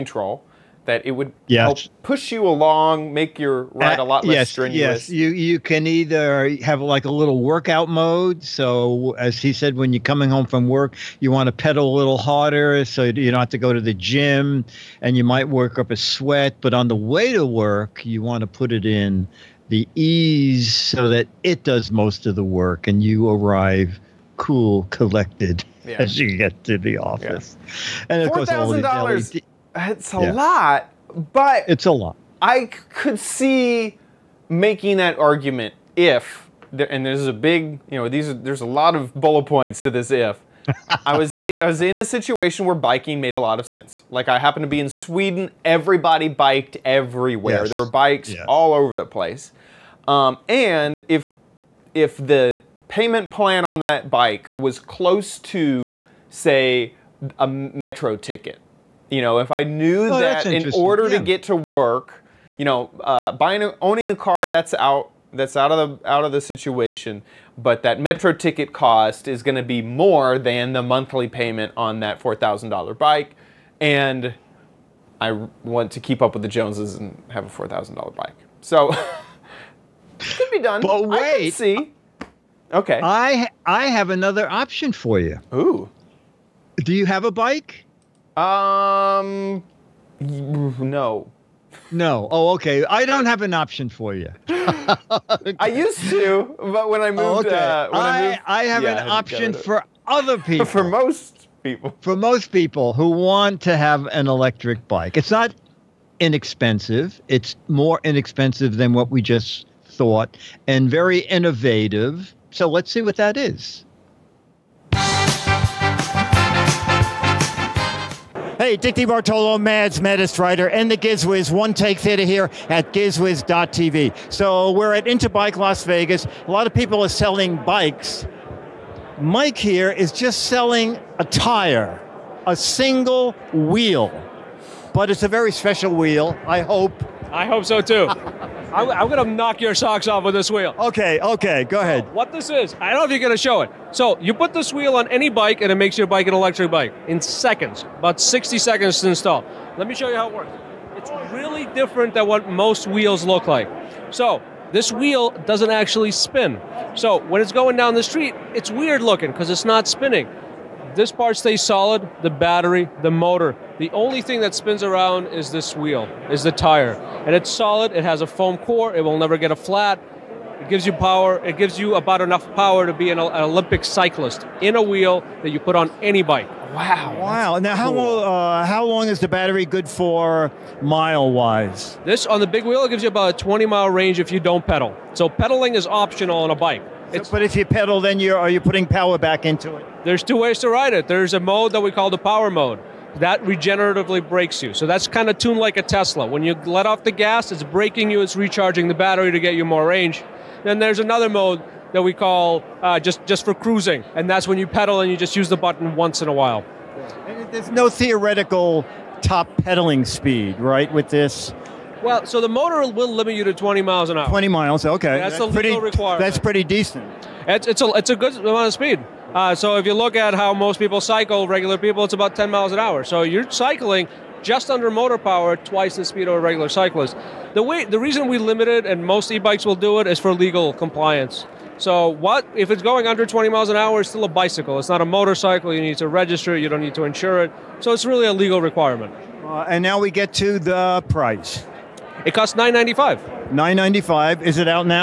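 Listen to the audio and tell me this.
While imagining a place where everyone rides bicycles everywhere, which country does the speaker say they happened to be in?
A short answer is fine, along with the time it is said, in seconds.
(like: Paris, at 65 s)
Sweden, at 44 s.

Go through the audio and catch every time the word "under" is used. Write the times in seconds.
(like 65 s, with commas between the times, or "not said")
224 s, 233 s.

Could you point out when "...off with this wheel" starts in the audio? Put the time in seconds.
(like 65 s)
140 s.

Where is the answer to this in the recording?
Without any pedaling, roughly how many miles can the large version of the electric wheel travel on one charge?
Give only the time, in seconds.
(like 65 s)
183 s.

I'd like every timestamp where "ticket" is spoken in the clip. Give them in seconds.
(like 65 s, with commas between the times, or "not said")
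58 s, 68 s.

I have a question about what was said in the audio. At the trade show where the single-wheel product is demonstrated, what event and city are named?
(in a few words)
Interbike Las Vegas.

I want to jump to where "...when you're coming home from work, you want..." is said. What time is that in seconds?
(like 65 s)
9 s.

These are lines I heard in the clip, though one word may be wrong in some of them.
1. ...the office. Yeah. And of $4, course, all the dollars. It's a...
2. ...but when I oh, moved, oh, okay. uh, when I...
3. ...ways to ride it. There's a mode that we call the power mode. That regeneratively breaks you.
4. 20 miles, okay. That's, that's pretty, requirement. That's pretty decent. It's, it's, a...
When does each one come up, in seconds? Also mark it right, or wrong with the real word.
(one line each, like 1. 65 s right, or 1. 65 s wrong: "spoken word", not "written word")
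1. 26 s right
2. 96 s right
3. 190 s right
4. 214 s right.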